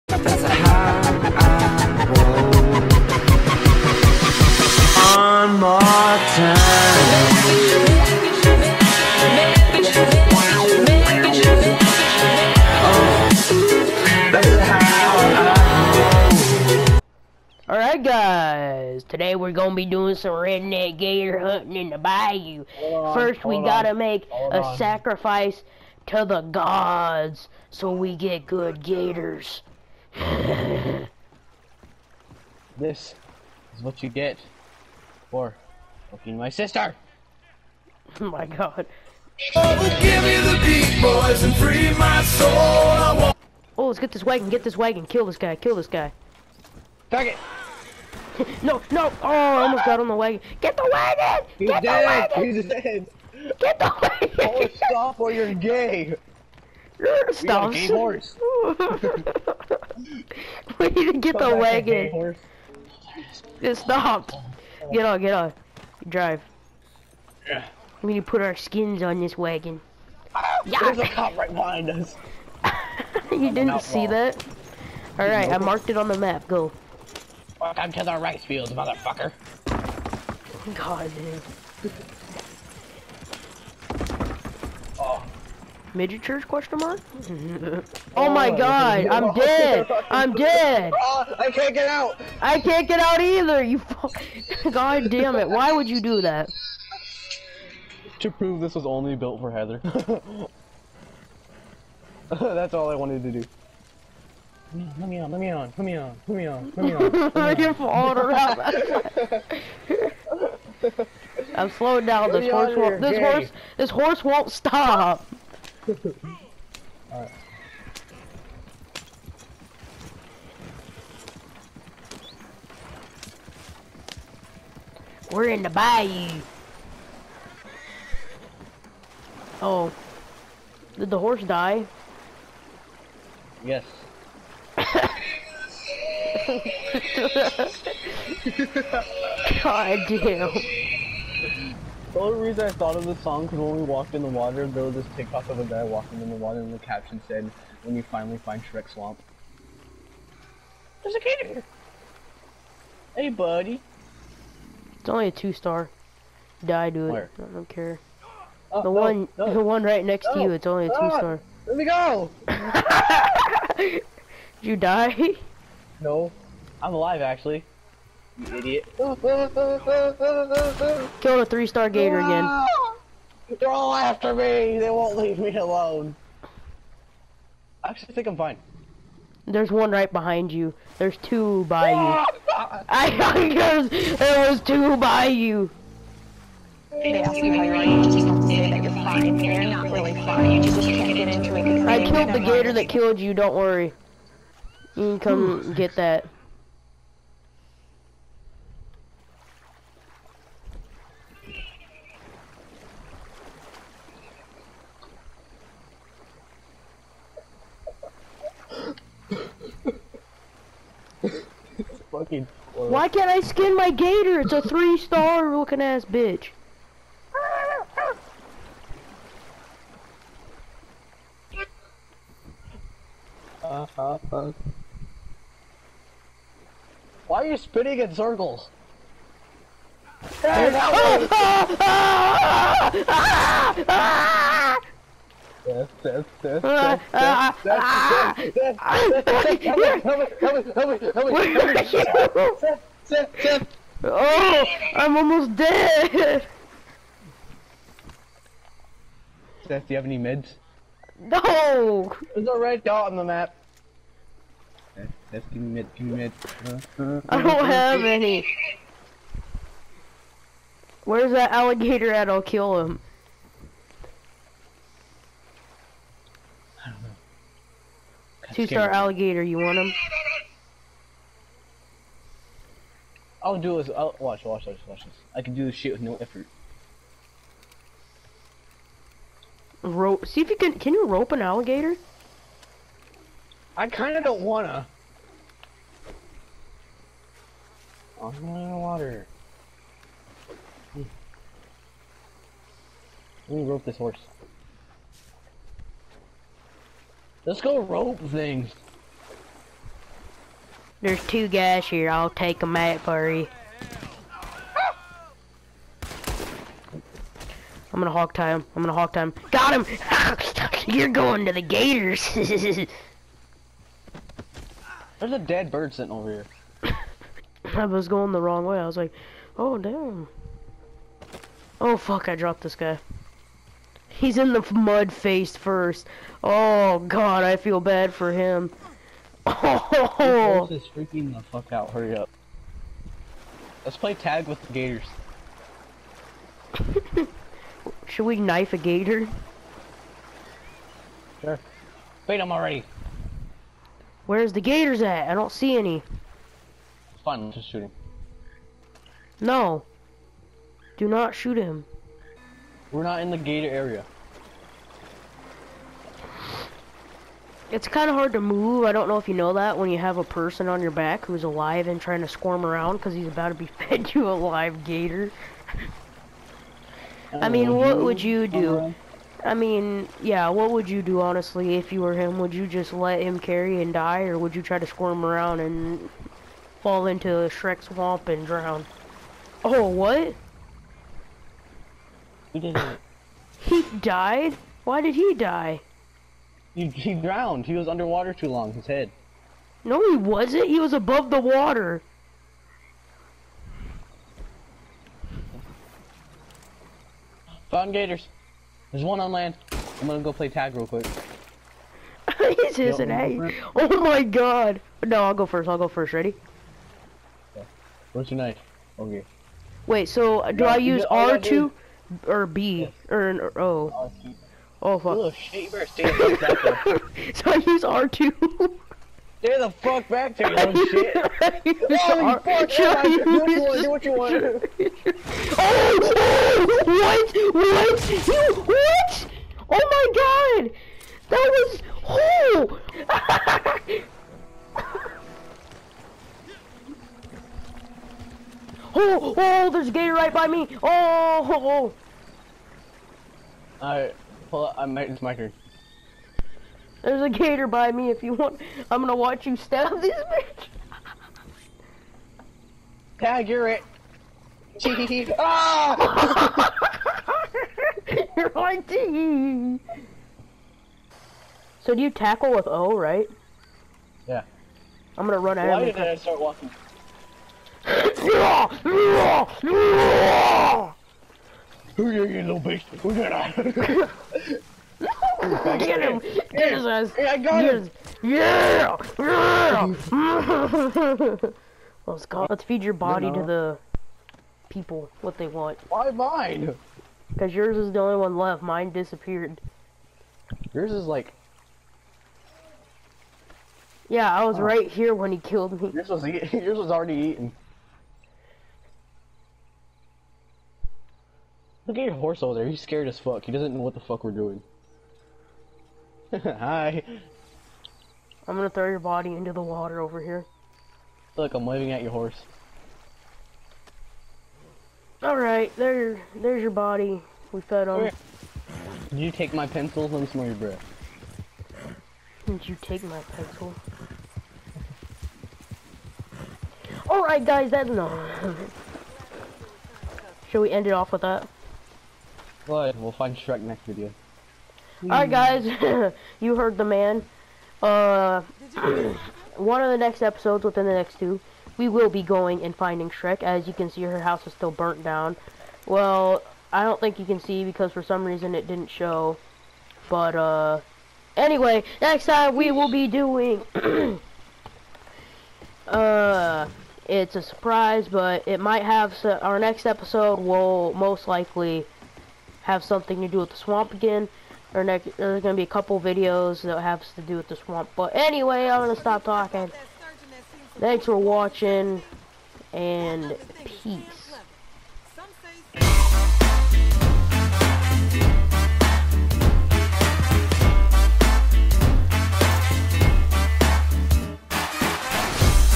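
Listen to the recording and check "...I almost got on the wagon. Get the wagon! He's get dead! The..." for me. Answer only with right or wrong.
right.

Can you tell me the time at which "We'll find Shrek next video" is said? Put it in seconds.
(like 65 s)
532 s.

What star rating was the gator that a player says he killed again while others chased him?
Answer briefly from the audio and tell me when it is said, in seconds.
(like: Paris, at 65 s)
3 star, at 171 s.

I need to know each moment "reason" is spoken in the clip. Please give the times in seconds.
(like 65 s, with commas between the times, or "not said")
142 s, 548 s.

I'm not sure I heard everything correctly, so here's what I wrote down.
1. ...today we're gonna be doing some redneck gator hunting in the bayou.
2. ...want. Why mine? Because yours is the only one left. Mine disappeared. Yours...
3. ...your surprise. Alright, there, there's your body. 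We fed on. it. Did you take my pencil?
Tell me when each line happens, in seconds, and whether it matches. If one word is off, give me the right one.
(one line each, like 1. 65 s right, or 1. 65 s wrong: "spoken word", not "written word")
1. 19 s right
2. 485 s right
3. 512 s wrong: "horse", not "surprise".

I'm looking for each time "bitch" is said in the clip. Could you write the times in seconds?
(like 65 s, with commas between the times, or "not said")
216 s, 450 s, 472 s.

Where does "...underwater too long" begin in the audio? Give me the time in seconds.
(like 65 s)
387 s.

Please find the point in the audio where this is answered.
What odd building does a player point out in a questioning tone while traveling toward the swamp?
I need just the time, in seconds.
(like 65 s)
85 s.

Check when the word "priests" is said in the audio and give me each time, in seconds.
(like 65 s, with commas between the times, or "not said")
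not said.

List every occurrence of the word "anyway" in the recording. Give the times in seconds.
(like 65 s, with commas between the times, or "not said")
551 s, 568 s.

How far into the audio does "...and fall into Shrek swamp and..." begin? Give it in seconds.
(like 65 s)
375 s.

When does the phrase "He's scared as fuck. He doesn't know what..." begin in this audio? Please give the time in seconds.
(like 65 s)
502 s.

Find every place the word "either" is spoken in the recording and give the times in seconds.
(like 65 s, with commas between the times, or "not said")
93 s.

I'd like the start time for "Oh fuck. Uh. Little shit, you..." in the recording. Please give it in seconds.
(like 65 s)
414 s.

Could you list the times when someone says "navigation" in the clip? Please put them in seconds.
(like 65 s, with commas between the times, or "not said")
not said.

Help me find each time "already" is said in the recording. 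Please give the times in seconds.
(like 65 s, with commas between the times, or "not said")
342 s, 496 s.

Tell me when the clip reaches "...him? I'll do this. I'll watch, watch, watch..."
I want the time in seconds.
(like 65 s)
269 s.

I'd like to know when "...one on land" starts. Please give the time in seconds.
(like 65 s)
399 s.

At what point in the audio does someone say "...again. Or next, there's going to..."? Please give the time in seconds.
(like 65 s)
563 s.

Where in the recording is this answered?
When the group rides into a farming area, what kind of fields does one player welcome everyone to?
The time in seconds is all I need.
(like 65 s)
78 s.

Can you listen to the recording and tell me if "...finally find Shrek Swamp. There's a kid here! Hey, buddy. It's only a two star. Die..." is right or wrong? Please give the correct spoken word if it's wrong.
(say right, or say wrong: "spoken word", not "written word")
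right.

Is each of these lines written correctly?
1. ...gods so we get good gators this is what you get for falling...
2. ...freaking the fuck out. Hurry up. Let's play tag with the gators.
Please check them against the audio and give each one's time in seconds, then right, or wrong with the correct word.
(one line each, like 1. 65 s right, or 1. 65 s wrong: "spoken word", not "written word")
1. 26 s wrong: "fucking", not "falling"
2. 330 s right.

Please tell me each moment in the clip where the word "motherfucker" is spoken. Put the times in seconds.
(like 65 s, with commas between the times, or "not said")
78 s.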